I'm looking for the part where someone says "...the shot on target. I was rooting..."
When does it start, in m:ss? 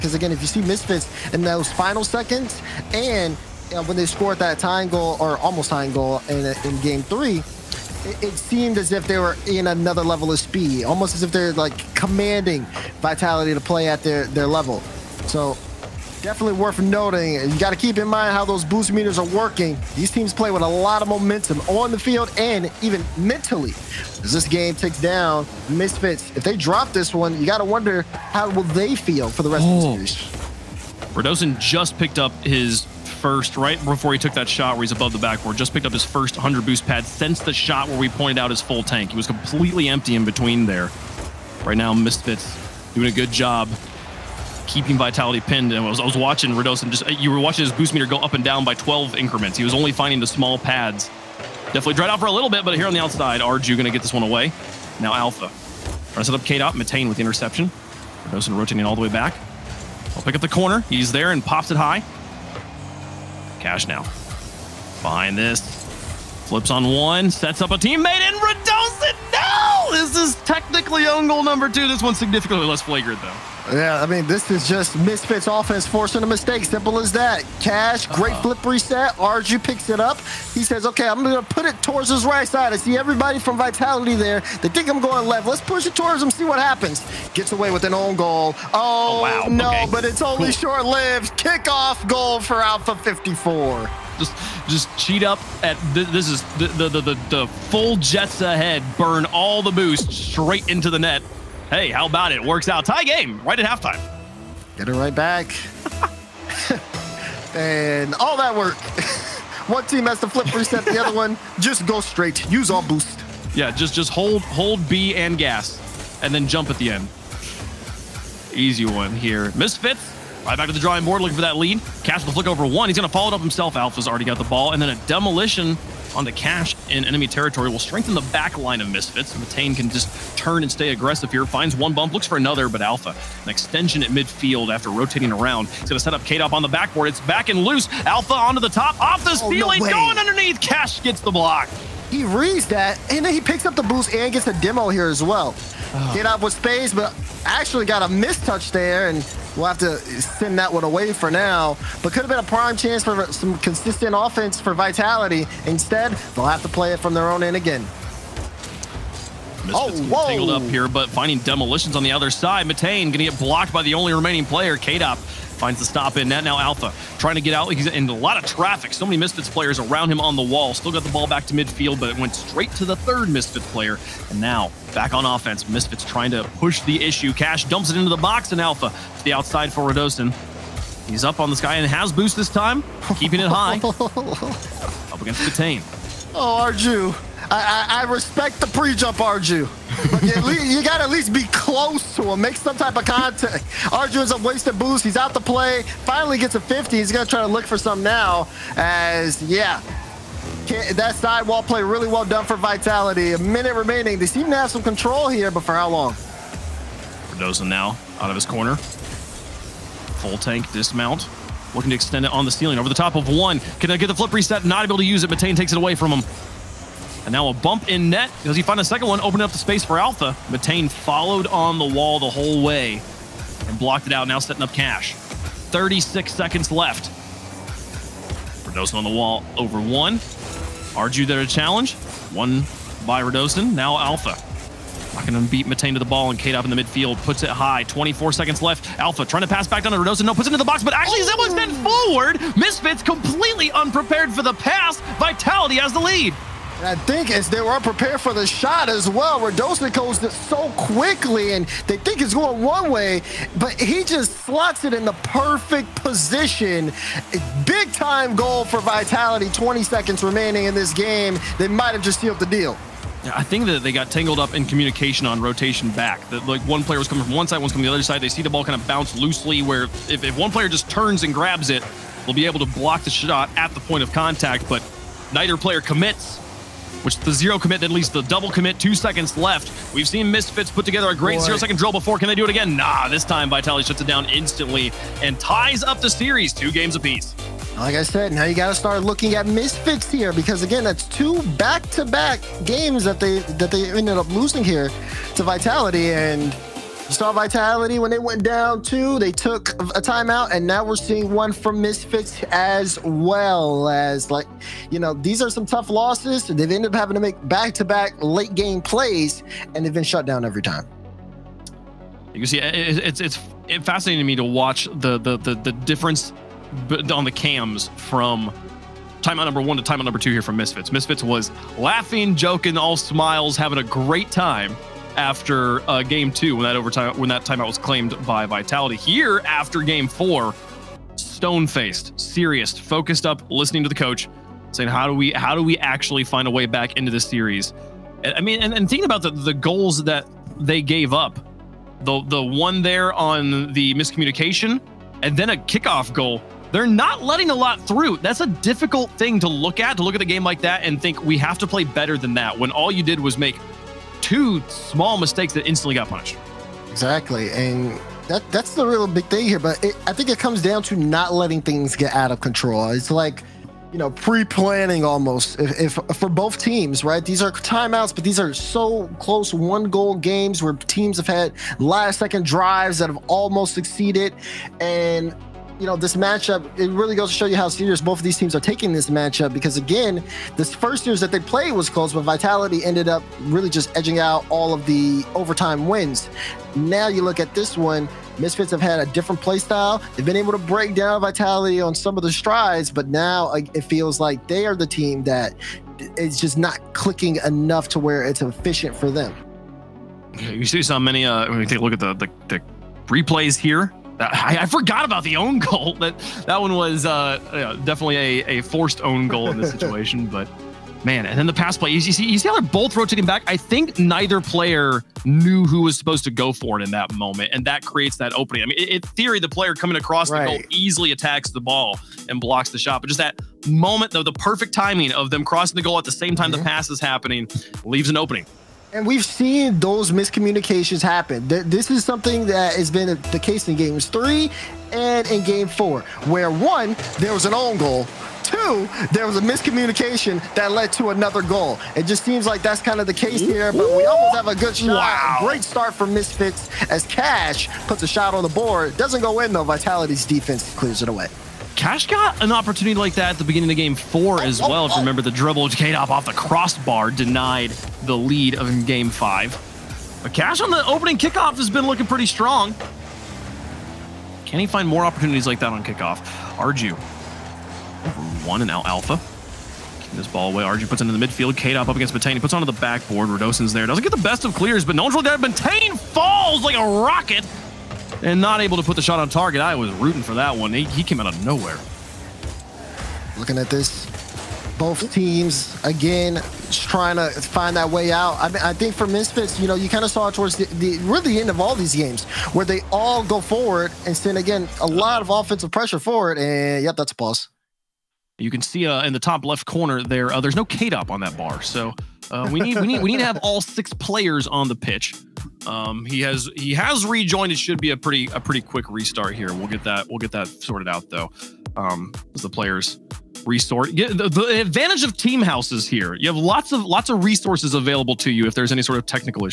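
7:58.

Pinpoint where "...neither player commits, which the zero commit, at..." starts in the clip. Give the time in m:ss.
4:35.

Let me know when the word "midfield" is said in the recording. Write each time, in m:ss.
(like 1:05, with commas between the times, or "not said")
2:14, 2:51, 3:56, 7:51.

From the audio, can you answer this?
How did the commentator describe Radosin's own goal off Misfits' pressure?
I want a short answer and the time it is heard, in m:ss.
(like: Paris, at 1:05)
Own goal number two, at 1:11.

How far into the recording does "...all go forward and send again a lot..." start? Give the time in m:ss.
8:12.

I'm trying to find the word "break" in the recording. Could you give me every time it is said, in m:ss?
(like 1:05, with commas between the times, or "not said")
6:30.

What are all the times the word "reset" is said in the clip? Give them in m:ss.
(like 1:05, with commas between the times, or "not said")
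1:18, 1:50, 3:34.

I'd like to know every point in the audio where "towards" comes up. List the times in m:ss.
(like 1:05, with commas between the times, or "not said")
1:21, 1:25, 8:10.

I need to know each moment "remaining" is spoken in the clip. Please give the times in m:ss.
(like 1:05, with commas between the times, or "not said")
2:44, 3:23, 4:20.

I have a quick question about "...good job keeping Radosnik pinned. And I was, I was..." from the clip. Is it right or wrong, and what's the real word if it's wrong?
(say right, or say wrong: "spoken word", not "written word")
wrong: "Vitality", not "Radosnik".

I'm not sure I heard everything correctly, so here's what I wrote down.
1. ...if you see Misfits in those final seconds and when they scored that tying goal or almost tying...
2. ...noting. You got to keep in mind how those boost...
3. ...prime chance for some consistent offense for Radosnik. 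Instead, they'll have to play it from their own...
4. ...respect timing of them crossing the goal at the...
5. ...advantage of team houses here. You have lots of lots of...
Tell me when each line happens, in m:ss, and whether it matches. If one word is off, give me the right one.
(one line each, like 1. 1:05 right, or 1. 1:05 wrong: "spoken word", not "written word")
1. 0:00 right
2. 0:16 right
3. 2:32 wrong: "Vitality", not "Radosnik"
4. 7:04 wrong: "perfect", not "respect"
5. 8:34 right.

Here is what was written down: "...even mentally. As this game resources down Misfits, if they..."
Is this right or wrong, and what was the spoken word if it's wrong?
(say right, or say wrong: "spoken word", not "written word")
wrong: "takes", not "resources".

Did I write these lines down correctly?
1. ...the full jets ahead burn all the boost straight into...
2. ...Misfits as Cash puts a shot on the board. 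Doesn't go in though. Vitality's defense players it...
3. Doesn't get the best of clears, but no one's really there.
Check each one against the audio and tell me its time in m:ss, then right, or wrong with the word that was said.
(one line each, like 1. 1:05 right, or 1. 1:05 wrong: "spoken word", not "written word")
1. 1:37 right
2. 7:26 wrong: "clears", not "players"
3. 7:53 right.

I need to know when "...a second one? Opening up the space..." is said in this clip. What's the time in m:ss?
3:38.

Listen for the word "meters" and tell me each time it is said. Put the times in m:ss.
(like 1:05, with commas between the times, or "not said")
0:18, 0:47.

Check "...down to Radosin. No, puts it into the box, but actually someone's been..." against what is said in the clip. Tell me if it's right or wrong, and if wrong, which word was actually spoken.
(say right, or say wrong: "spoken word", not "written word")
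right.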